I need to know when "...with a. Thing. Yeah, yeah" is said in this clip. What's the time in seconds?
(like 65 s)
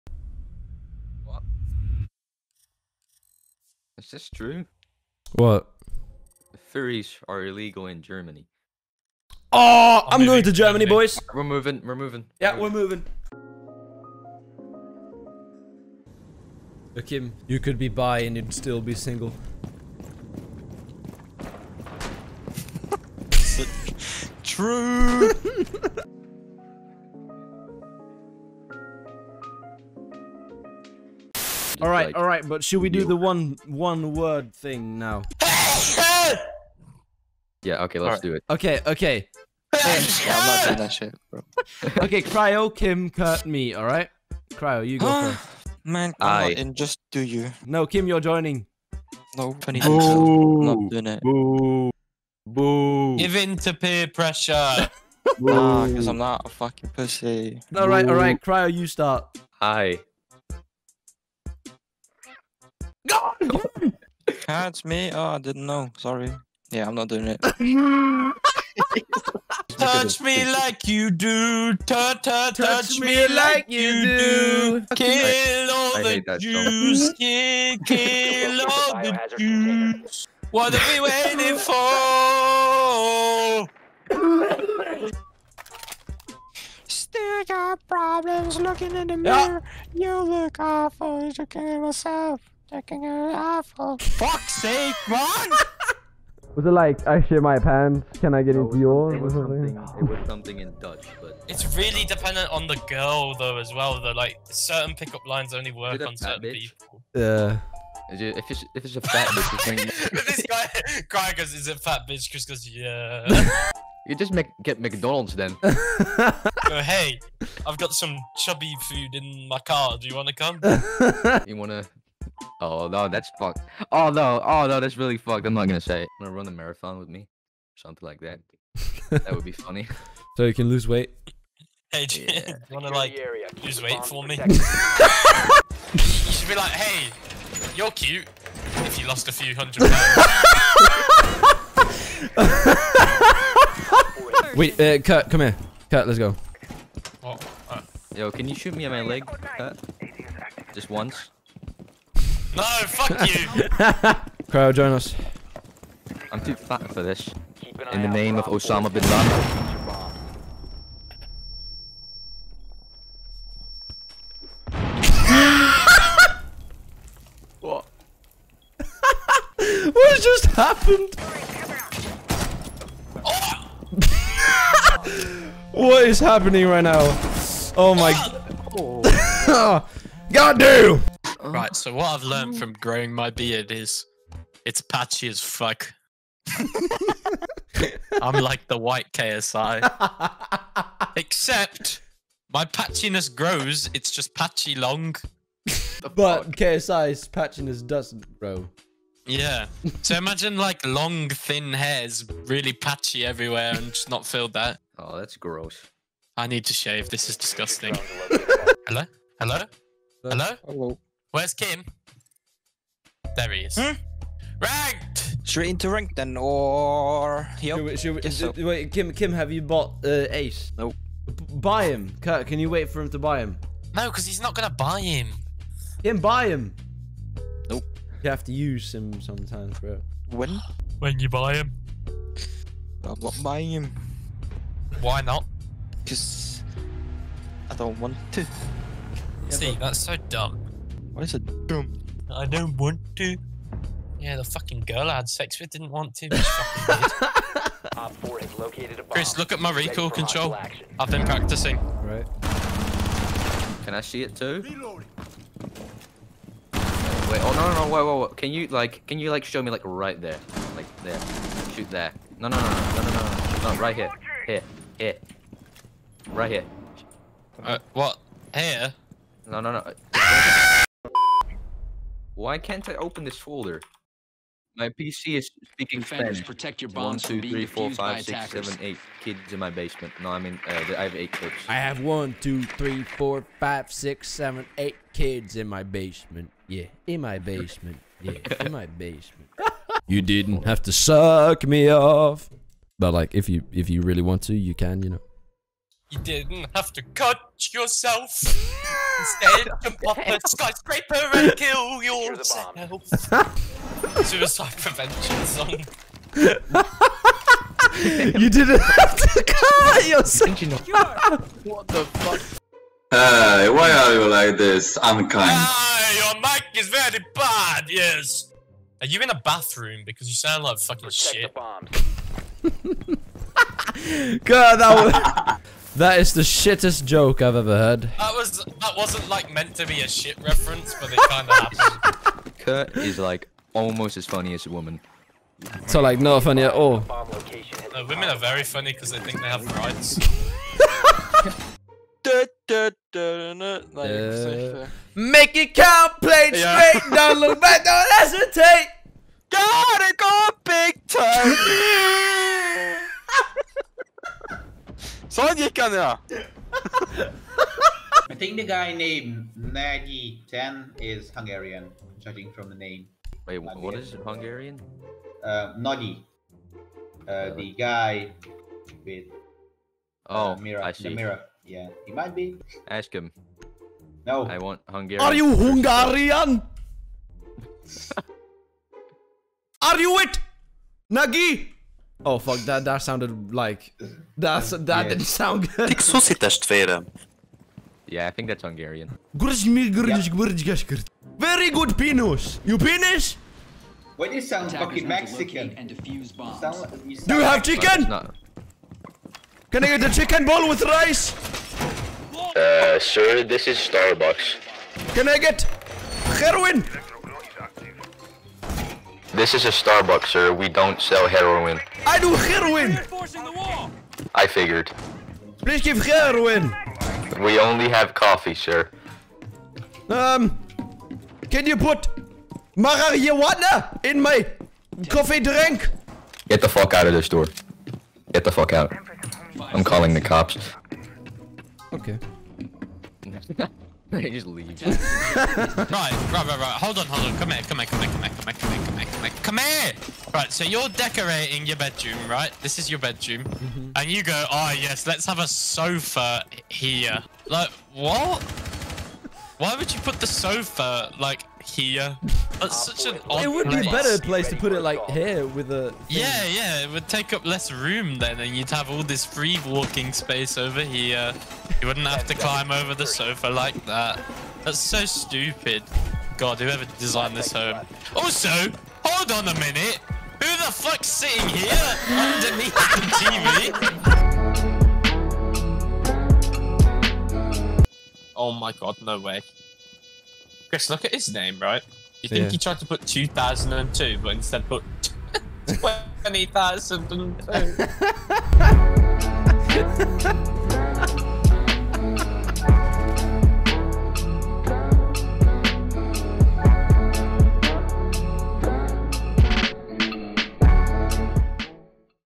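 455 s.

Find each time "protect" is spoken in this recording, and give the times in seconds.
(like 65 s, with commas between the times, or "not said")
276 s, 321 s.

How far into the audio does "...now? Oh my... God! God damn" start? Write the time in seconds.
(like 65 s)
176 s.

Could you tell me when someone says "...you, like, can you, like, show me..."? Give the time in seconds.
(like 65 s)
258 s.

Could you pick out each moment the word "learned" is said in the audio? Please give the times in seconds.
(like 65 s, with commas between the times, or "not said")
182 s.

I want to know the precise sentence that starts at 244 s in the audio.
Yeah, the fucking girl I had sex with didn't want to.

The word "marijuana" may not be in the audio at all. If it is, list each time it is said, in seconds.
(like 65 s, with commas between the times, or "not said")
422 s.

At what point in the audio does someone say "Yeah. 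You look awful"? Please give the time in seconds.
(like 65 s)
89 s.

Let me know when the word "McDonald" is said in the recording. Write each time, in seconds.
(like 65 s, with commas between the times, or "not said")
114 s.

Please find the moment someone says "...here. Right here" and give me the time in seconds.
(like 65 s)
264 s.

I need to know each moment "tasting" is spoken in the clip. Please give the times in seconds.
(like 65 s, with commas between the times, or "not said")
not said.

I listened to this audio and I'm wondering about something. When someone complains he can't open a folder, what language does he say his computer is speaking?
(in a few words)
Spanish.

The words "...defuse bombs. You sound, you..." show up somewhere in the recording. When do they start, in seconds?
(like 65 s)
395 s.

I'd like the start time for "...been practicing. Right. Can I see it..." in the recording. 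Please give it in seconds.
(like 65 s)
251 s.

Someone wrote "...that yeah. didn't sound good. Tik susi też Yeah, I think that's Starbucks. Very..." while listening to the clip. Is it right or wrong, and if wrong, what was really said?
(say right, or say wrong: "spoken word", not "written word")
wrong: "Hungarian", not "Starbucks".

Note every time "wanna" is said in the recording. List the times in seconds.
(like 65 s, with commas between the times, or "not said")
126 s, 132 s.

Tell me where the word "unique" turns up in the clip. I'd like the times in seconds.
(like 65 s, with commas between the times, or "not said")
not said.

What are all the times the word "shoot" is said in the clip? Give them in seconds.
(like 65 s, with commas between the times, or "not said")
148 s, 261 s.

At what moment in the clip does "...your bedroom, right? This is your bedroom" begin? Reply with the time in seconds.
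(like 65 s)
441 s.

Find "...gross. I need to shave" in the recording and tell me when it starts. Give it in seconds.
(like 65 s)
205 s.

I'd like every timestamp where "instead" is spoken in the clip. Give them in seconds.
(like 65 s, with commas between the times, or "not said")
298 s, 484 s.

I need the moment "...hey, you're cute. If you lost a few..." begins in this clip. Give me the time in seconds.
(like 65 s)
136 s.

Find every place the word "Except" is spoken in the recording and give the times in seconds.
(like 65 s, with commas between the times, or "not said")
191 s.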